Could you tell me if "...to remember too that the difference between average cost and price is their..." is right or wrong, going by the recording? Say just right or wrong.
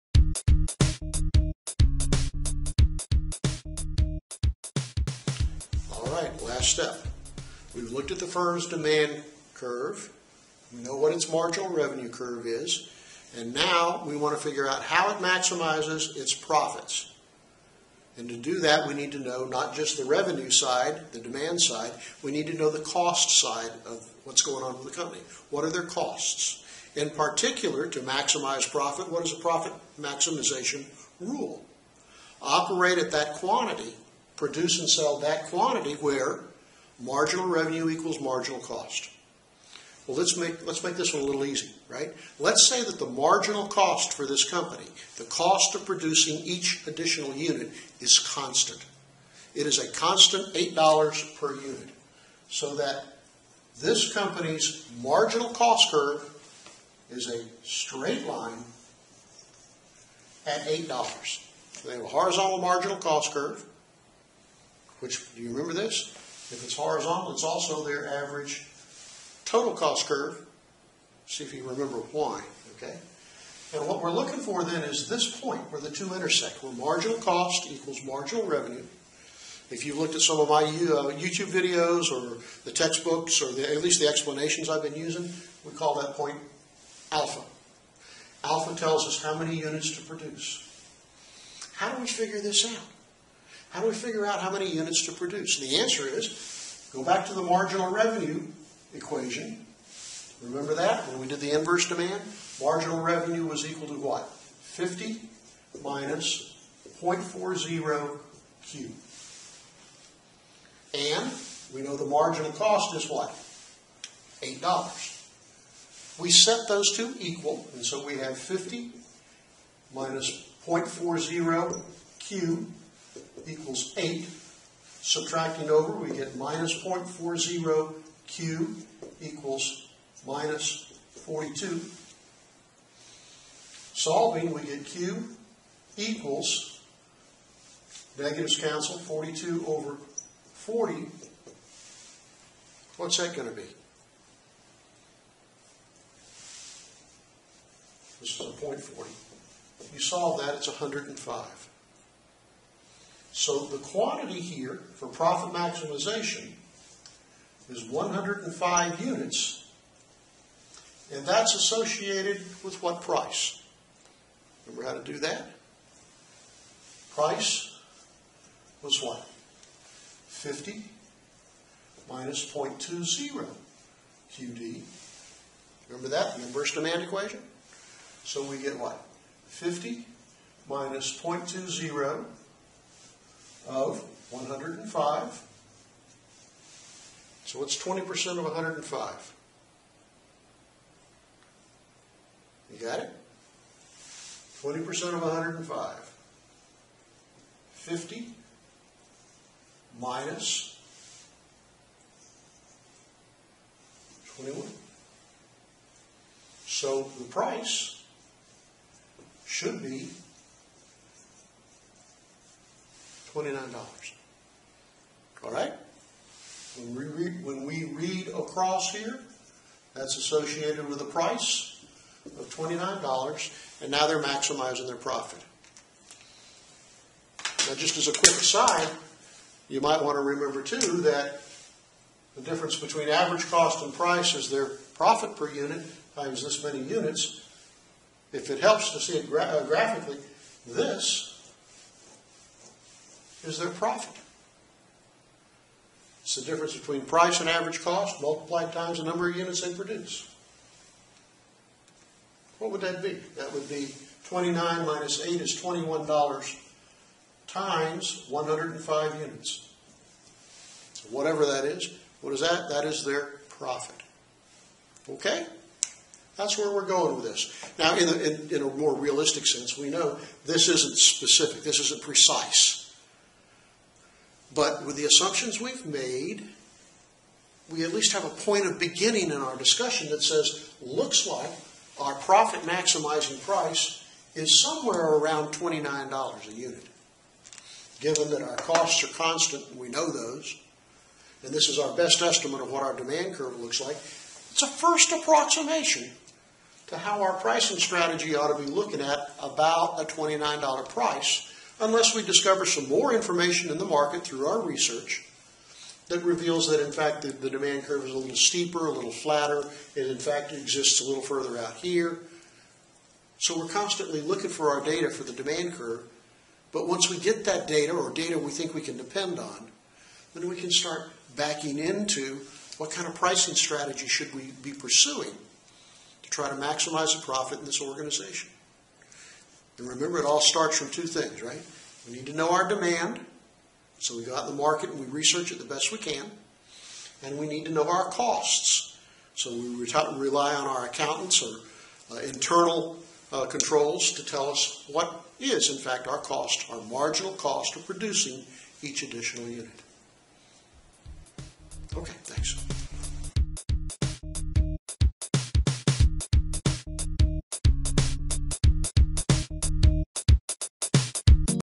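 right.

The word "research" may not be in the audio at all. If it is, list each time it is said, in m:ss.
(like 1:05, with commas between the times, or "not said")
5:04, 5:35.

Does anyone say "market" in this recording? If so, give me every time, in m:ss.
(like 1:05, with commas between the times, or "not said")
5:03, 5:34.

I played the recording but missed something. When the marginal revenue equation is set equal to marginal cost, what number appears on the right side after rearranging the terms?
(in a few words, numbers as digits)
-42.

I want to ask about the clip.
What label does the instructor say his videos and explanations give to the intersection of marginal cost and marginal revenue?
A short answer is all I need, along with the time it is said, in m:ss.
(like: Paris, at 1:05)
alpha, at 1:25.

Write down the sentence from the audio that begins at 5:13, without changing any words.
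So we're constantly looking for our data for the demand curve.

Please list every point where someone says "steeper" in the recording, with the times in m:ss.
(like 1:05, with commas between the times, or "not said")
5:08.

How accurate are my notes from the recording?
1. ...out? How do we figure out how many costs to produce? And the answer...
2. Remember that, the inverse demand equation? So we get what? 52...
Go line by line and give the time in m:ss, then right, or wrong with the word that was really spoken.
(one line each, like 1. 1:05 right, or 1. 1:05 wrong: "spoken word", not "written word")
1. 1:32 wrong: "units", not "costs"
2. 2:55 wrong: "50", not "52".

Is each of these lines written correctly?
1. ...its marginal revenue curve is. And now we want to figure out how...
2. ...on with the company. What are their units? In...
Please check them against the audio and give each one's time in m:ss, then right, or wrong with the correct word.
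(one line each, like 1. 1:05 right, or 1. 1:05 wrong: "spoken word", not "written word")
1. 0:11 right
2. 0:24 wrong: "costs", not "units".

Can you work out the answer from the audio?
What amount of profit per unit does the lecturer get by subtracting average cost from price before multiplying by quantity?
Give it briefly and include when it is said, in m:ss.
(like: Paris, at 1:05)
$21, at 4:15.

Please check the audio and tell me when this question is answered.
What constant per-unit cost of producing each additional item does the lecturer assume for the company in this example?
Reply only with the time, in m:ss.
0:49.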